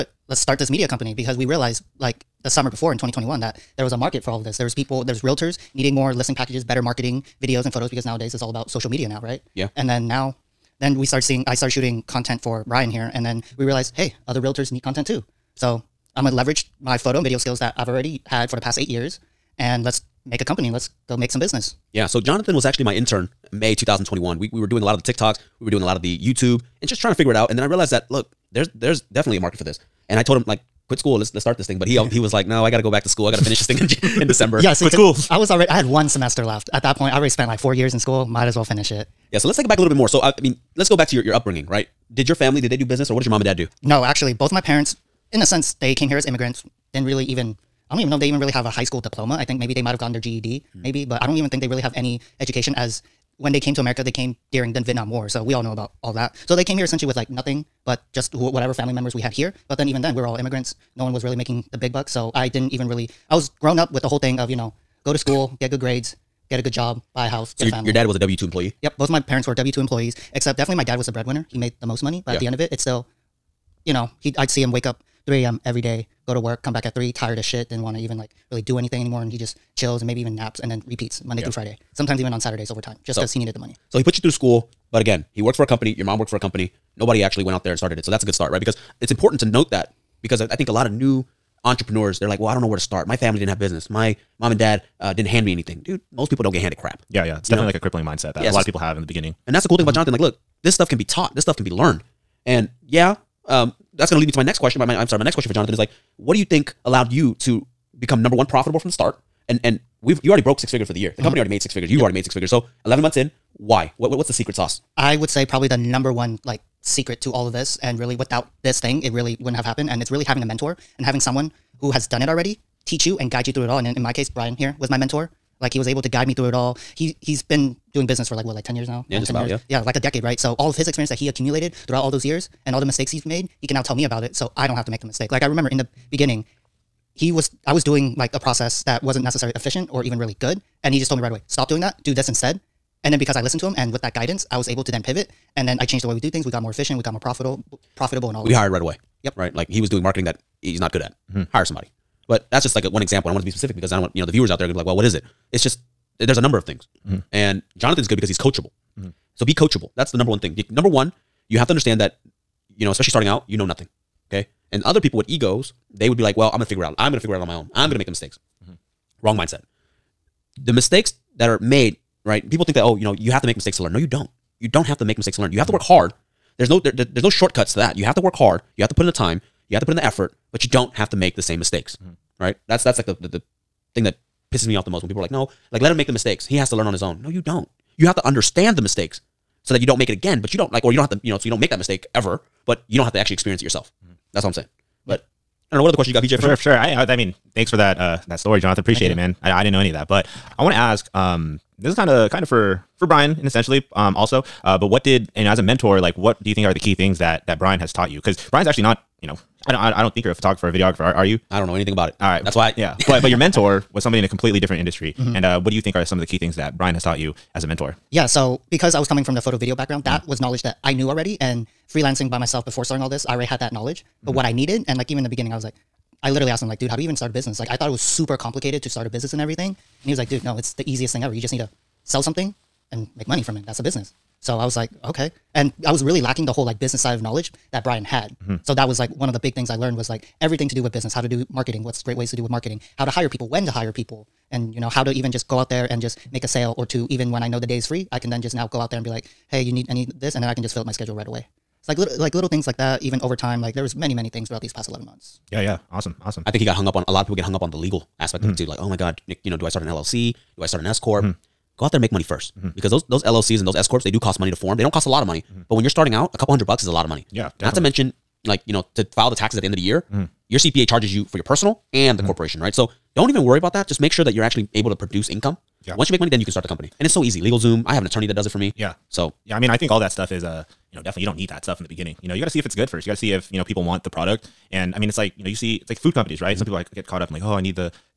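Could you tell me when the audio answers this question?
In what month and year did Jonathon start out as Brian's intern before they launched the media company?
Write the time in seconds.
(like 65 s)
23 s.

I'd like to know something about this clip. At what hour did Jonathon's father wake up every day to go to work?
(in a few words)
3 a.m.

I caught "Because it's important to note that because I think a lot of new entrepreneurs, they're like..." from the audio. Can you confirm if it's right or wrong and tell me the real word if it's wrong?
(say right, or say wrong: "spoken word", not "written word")
right.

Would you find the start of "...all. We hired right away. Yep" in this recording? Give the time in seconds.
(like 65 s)
148 s.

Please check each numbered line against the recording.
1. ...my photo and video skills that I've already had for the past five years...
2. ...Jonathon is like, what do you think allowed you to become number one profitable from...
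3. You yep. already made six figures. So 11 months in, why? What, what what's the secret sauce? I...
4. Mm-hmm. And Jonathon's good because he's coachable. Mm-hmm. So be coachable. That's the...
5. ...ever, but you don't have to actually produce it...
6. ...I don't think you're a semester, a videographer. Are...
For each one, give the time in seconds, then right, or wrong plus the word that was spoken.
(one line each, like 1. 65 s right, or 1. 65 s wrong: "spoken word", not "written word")
1. 16 s wrong: "eight", not "five"
2. 105 s right
3. 111 s right
4. 157 s right
5. 192 s wrong: "experience", not "produce"
6. 210 s wrong: "photographer", not "semester".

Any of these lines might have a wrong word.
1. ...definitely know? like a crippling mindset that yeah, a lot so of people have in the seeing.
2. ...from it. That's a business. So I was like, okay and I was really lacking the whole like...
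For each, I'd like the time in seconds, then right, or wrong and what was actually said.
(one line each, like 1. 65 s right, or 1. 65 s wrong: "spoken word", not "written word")
1. 97 s wrong: "beginning", not "seeing"
2. 233 s right.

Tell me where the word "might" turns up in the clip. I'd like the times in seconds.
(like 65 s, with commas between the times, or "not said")
38 s, 49 s.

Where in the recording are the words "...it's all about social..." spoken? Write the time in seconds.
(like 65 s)
8 s.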